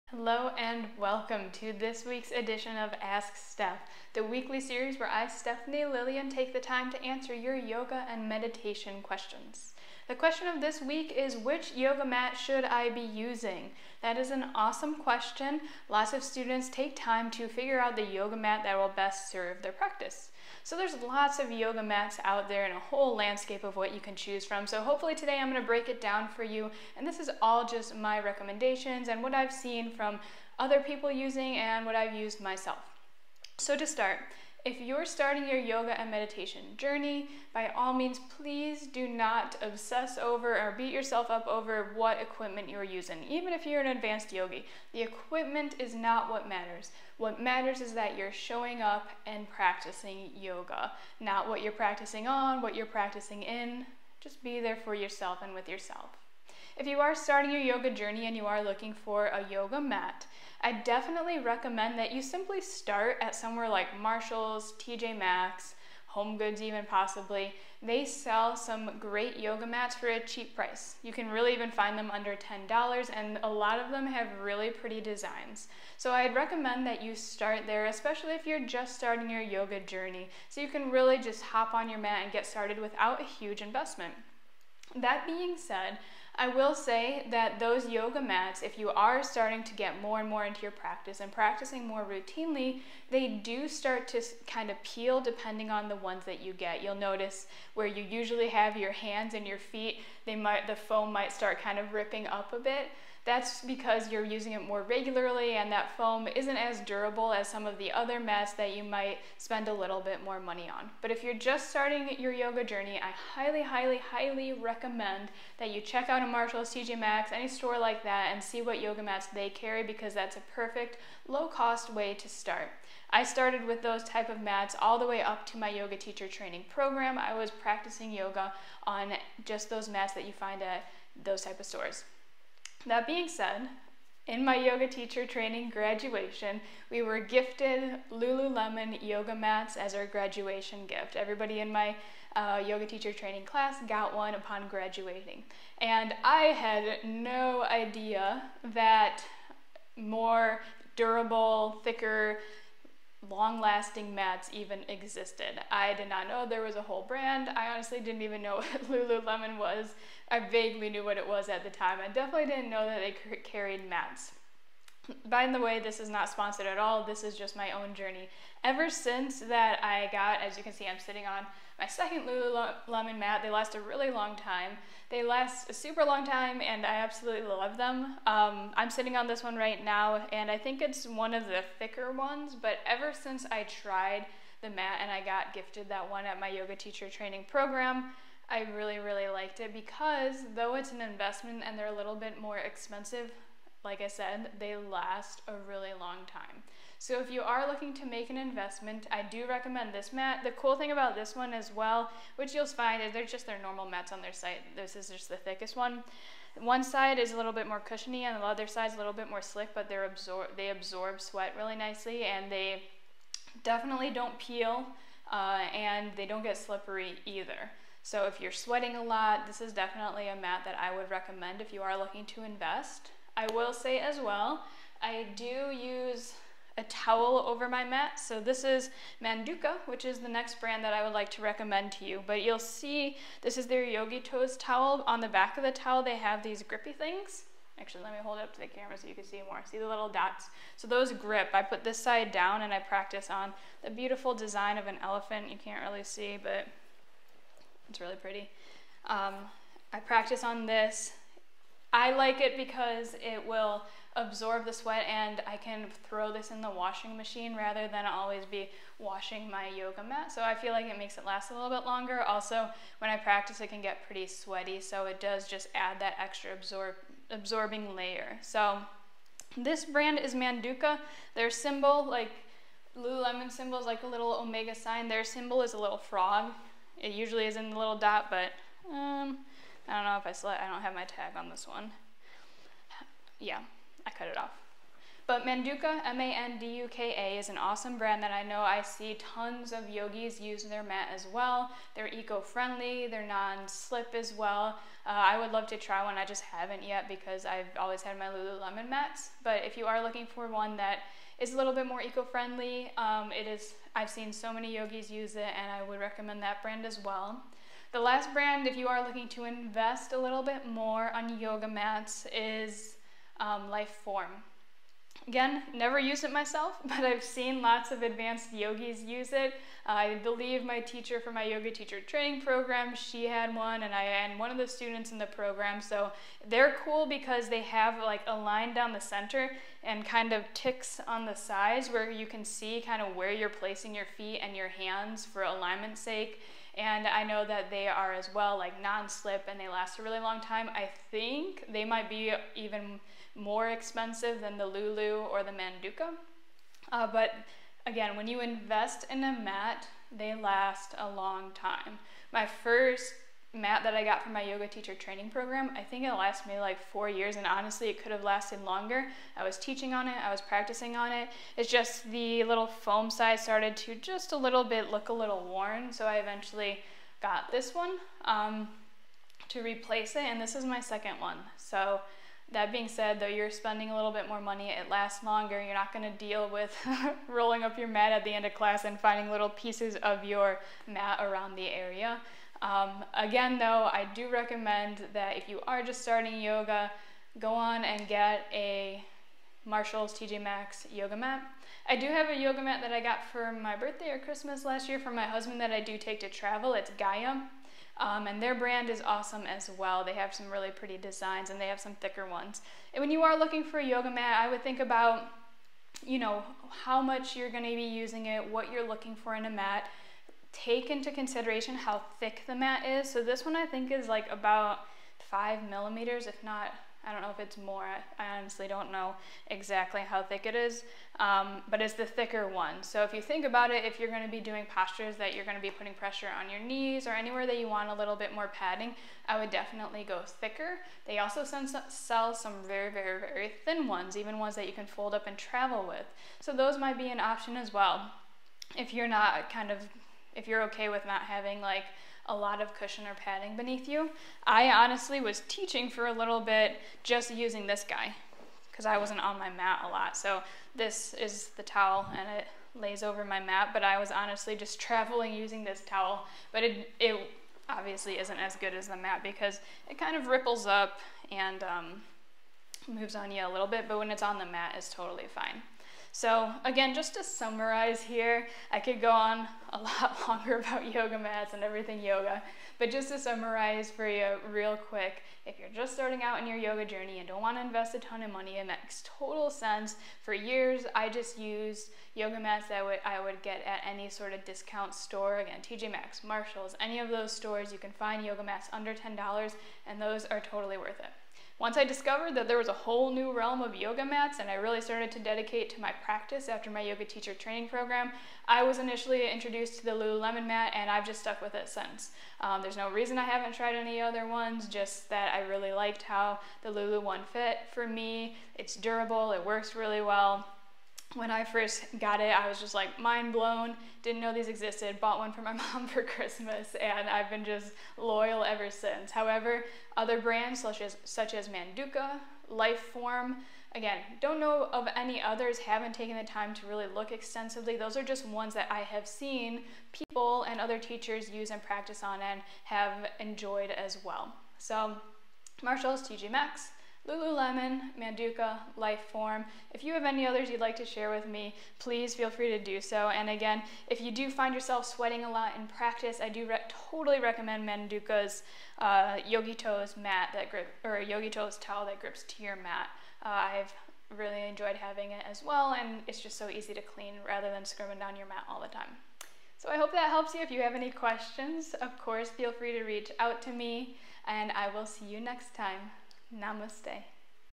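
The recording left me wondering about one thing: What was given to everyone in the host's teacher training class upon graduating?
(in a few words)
Lululemon yoga mats.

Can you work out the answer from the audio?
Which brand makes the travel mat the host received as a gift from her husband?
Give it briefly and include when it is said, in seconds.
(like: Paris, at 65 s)
Gaia, at 396 s.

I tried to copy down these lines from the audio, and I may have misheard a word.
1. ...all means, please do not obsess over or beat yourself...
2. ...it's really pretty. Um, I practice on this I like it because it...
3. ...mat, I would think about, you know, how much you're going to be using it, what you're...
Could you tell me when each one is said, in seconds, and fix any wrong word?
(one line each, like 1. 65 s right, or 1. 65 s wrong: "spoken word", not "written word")
1. 37 s right
2. 247 s right
3. 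404 s right.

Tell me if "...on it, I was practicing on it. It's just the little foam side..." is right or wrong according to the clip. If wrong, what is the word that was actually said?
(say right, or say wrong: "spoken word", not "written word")
right.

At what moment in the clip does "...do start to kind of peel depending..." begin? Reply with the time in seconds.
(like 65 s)
93 s.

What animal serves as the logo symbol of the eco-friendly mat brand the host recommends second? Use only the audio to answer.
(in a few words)
frog.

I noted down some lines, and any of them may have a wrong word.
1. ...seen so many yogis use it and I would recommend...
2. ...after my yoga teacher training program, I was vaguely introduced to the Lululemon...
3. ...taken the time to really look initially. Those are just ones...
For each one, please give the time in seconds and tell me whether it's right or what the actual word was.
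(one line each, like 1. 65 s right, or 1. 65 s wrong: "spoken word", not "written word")
1. 304 s right
2. 496 s wrong: "initially", not "vaguely"
3. 525 s wrong: "extensively", not "initially".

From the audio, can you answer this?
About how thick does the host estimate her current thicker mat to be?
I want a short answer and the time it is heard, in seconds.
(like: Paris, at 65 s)
5 millimeters, at 415 s.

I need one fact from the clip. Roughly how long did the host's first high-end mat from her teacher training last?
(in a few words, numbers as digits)
4 years.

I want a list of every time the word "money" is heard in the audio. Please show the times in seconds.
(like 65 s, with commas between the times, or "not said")
110 s, 374 s, 478 s.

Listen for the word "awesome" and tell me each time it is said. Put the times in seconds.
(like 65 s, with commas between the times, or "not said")
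14 s, 287 s, 399 s.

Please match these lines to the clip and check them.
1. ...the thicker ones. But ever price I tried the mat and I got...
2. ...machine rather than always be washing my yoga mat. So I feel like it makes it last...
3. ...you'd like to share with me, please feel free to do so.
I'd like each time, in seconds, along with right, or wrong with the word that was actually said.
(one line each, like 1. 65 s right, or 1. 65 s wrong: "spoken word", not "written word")
1. 181 s wrong: "since", not "price"
2. 257 s right
3. 540 s right.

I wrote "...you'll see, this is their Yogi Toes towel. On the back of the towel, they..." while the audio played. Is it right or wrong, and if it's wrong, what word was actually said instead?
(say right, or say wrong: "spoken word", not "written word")
right.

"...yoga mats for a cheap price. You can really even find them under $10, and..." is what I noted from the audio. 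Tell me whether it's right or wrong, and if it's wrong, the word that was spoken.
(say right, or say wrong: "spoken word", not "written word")
right.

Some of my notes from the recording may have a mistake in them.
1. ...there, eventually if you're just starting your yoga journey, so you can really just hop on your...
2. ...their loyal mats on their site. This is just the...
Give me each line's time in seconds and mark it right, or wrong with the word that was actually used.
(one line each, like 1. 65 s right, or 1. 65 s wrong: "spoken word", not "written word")
1. 77 s wrong: "especially", not "eventually"
2. 203 s wrong: "normal", not "loyal".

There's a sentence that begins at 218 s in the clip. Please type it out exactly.
So if you're sweating a lot, this is definitely a mat that I would recommend if you are looking to invest.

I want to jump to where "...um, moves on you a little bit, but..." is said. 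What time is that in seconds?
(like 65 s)
461 s.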